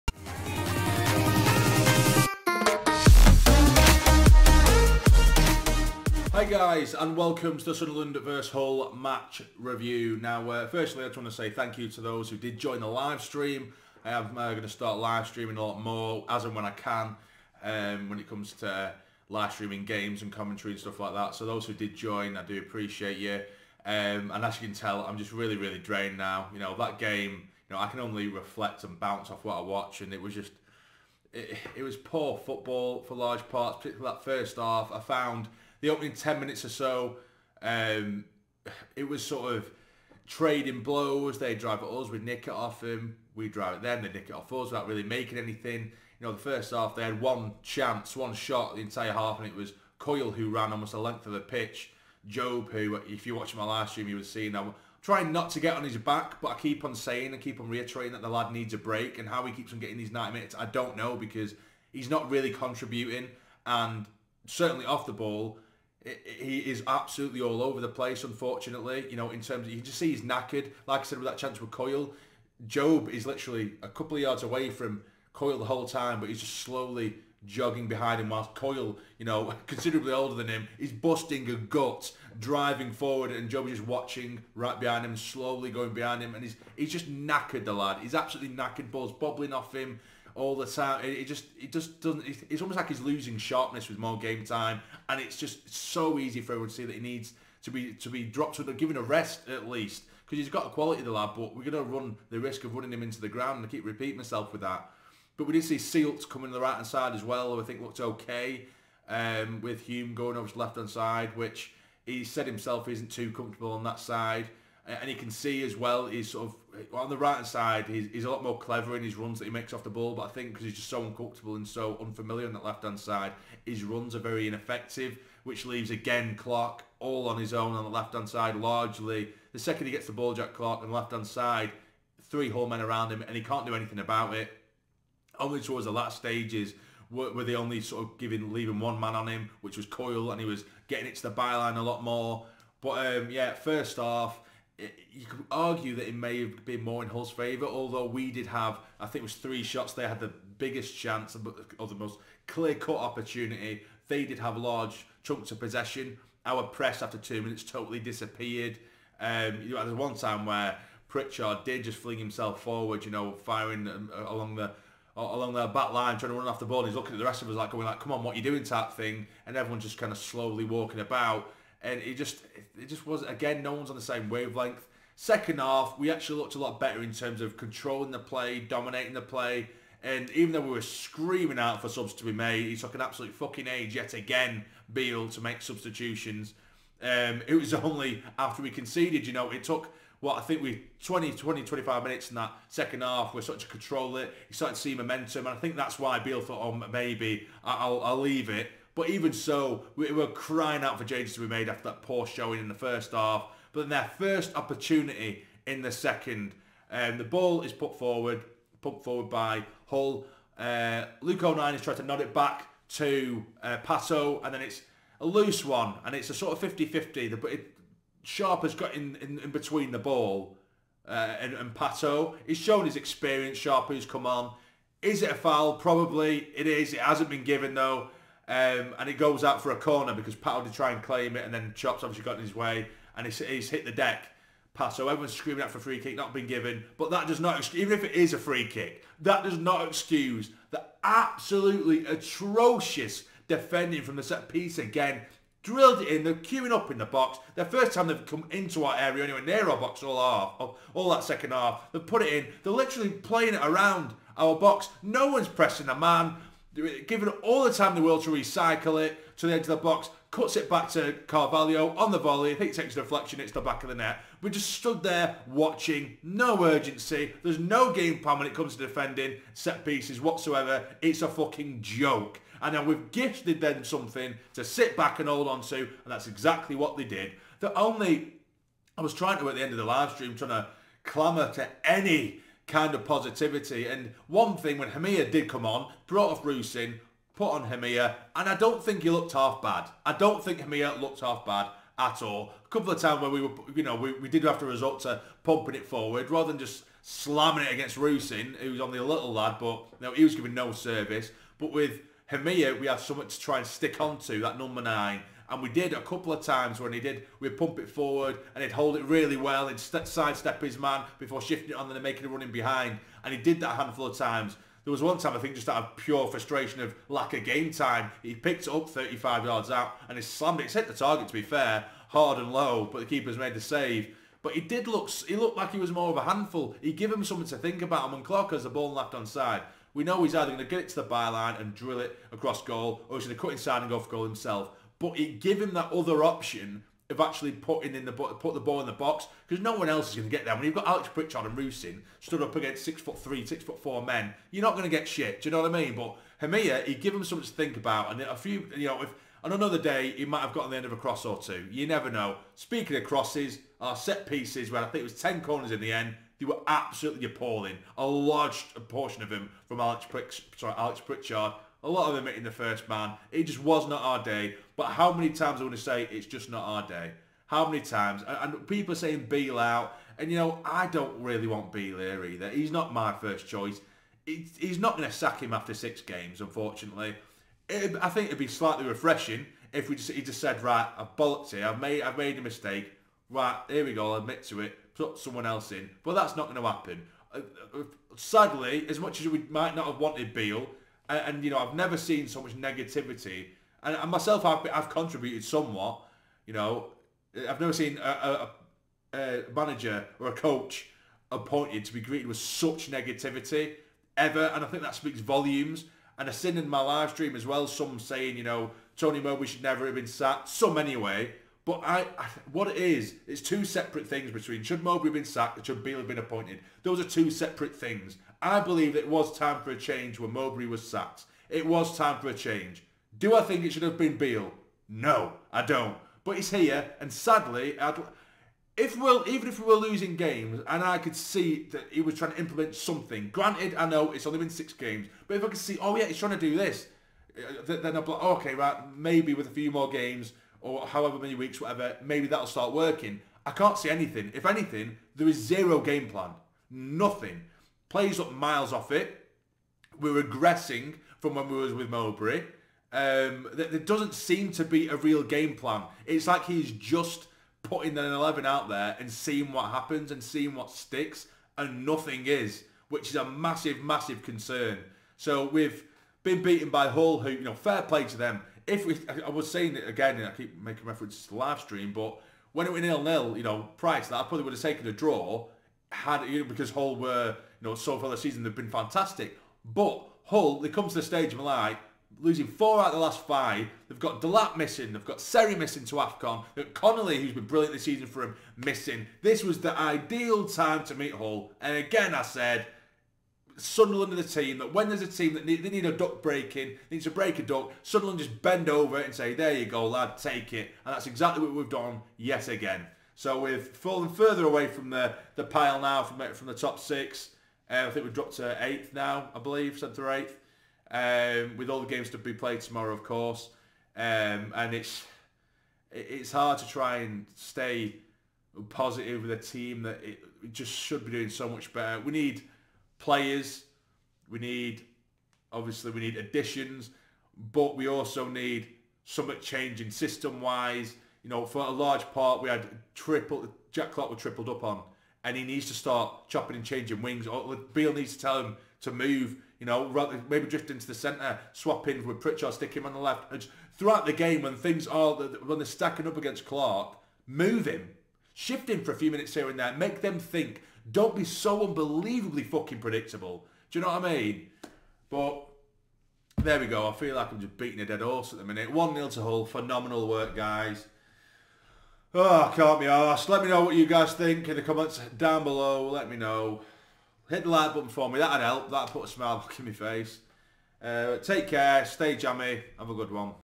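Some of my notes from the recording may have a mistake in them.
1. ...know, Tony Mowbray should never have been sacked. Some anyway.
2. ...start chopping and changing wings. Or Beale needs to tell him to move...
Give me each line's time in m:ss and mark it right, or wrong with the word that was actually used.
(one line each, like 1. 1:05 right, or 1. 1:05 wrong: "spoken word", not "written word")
1. 6:48 right
2. 8:55 right.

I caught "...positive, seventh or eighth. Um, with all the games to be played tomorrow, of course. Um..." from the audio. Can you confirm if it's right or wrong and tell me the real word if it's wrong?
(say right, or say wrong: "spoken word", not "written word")
wrong: "believe", not "positive".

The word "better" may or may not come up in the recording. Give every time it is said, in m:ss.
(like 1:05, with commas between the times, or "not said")
2:56, 8:41.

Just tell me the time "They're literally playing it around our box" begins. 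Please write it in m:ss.
4:12.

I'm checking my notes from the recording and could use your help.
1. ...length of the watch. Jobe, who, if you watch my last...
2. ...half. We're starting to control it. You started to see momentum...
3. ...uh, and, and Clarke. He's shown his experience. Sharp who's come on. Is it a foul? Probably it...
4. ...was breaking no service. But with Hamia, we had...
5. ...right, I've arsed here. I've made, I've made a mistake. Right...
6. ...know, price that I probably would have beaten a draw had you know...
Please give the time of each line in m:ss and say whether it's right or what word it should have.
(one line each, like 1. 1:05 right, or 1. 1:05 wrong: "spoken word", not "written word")
1. 0:50 wrong: "pitch", not "watch"
2. 3:13 right
3. 3:41 wrong: "Pato", not "Clarke"
4. 5:00 wrong: "giving", not "breaking"
5. 6:20 wrong: "bollocked", not "arsed"
6. 7:53 wrong: "taken", not "beaten".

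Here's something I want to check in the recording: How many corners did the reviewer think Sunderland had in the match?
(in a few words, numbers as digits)
10.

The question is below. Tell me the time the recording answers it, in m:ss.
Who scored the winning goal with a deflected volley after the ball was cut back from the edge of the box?
4:20.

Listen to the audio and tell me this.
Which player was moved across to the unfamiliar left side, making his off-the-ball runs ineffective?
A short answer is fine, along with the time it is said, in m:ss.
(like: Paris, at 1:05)
Hume, at 1:49.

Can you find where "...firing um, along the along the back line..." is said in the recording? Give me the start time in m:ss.
2:43.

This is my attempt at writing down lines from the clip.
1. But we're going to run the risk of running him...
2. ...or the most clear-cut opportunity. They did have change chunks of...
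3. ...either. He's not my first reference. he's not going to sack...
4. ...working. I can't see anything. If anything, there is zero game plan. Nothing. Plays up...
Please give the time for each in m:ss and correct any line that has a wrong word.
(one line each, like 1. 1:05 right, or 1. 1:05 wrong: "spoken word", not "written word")
1. 1:41 right
2. 2:31 wrong: "large", not "change"
3. 6:12 wrong: "choice", not "reference"
4. 7:22 right.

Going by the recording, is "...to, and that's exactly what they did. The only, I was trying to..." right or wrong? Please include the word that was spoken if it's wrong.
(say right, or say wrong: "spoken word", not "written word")
right.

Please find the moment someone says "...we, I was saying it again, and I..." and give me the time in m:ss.
7:48.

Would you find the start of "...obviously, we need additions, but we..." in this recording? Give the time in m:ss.
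8:45.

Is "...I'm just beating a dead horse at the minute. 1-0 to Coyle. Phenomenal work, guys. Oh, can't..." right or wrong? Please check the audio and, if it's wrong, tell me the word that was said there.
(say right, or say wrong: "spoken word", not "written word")
wrong: "Hull", not "Coyle".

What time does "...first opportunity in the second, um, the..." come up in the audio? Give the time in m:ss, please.
3:24.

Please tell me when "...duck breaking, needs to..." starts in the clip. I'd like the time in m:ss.
8:15.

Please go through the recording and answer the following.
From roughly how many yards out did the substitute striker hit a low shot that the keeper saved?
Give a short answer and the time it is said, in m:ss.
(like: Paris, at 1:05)
35, at 5:18.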